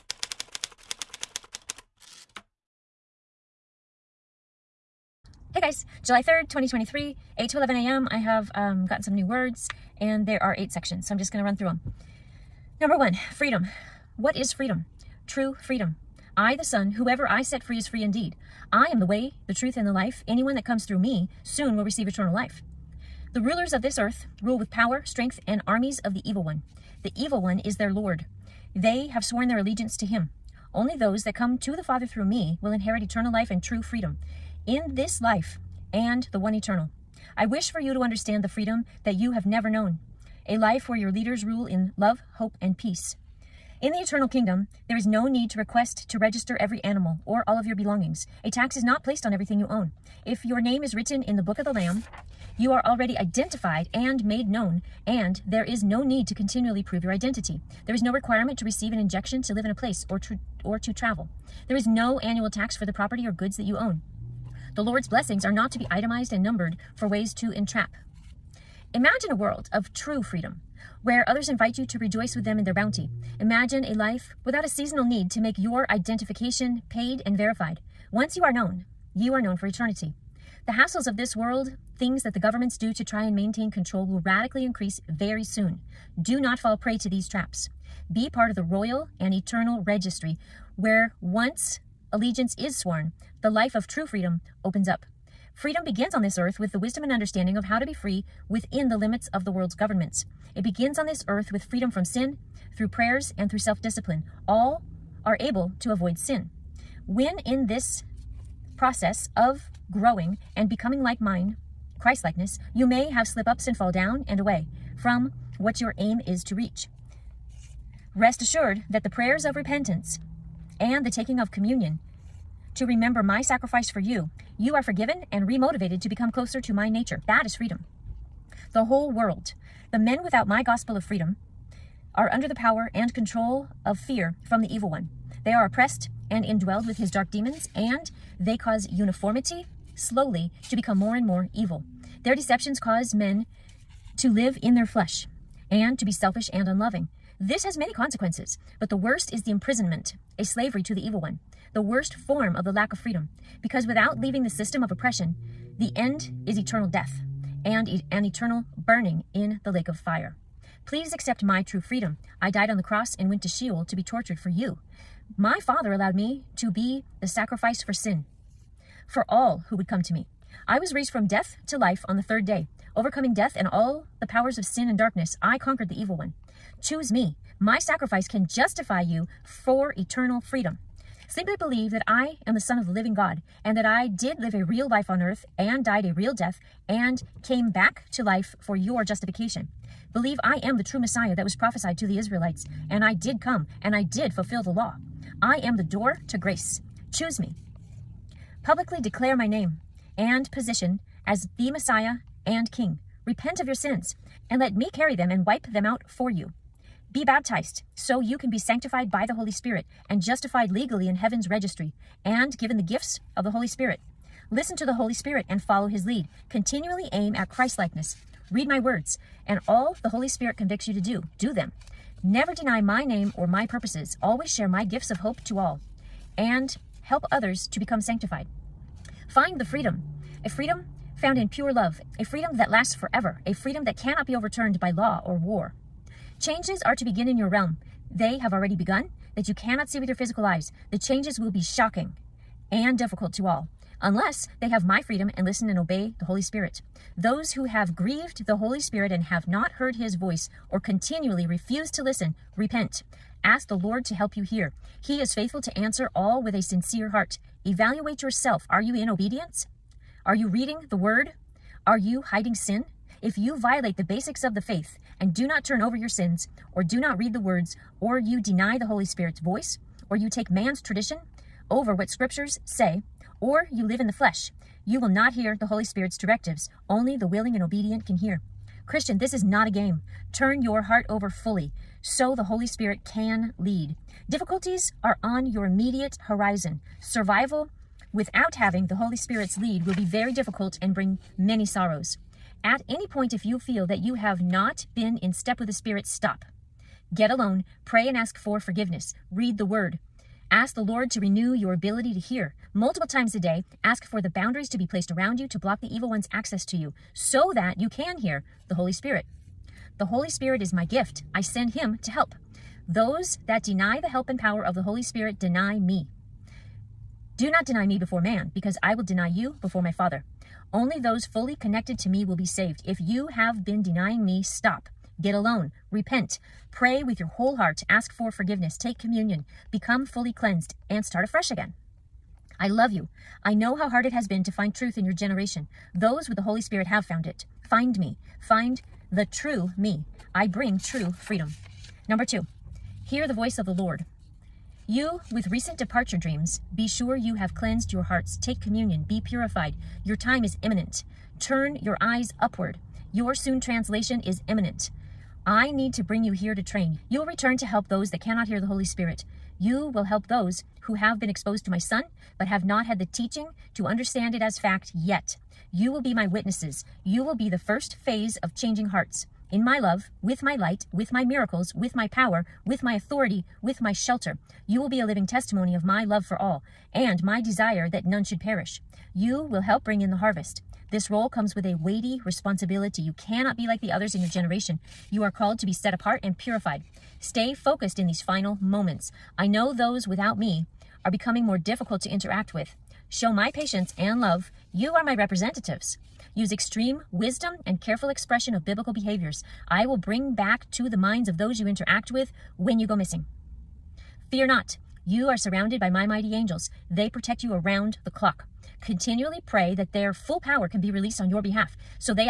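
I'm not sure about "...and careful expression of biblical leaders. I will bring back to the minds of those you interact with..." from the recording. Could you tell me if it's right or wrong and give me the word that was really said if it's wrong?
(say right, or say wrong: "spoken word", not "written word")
wrong: "behaviors", not "leaders".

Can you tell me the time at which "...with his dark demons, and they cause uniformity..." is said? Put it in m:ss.
2:16.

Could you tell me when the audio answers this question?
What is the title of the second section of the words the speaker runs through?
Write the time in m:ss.
5:43.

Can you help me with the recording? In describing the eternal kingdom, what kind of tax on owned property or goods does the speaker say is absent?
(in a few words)
annual tax.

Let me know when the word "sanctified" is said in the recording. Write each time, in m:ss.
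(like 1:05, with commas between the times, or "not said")
3:28, 3:47.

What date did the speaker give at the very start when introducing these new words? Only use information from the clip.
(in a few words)
July 3rd, 2023.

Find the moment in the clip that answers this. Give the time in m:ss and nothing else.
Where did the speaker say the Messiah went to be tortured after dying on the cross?
2:43.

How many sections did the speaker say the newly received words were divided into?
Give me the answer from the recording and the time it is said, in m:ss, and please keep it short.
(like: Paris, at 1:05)
8, at 0:10.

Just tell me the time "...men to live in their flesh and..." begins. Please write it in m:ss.
2:23.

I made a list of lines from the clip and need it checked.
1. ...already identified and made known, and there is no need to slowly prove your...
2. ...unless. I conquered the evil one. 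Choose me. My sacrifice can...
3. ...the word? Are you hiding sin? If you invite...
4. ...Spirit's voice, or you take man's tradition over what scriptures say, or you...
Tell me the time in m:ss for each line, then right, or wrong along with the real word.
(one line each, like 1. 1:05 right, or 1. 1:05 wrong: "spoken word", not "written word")
1. 0:52 wrong: "continually", not "slowly"
2. 2:54 wrong: "darkness", not "unless"
3. 4:20 wrong: "violate", not "invite"
4. 4:29 right.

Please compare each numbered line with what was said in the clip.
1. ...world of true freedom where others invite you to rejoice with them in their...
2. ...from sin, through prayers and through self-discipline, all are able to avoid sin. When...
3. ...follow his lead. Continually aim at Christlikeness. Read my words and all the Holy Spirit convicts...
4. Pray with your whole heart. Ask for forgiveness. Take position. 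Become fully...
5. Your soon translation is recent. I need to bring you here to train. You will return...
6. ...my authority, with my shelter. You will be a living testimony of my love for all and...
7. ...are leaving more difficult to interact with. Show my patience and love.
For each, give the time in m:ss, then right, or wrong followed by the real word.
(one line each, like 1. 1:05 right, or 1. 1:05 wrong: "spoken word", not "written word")
1. 1:09 right
2. 1:41 right
3. 3:35 right
4. 5:26 wrong: "communion", not "position"
5. 5:53 wrong: "imminent", not "recent"
6. 6:12 right
7. 6:31 wrong: "becoming", not "leaving".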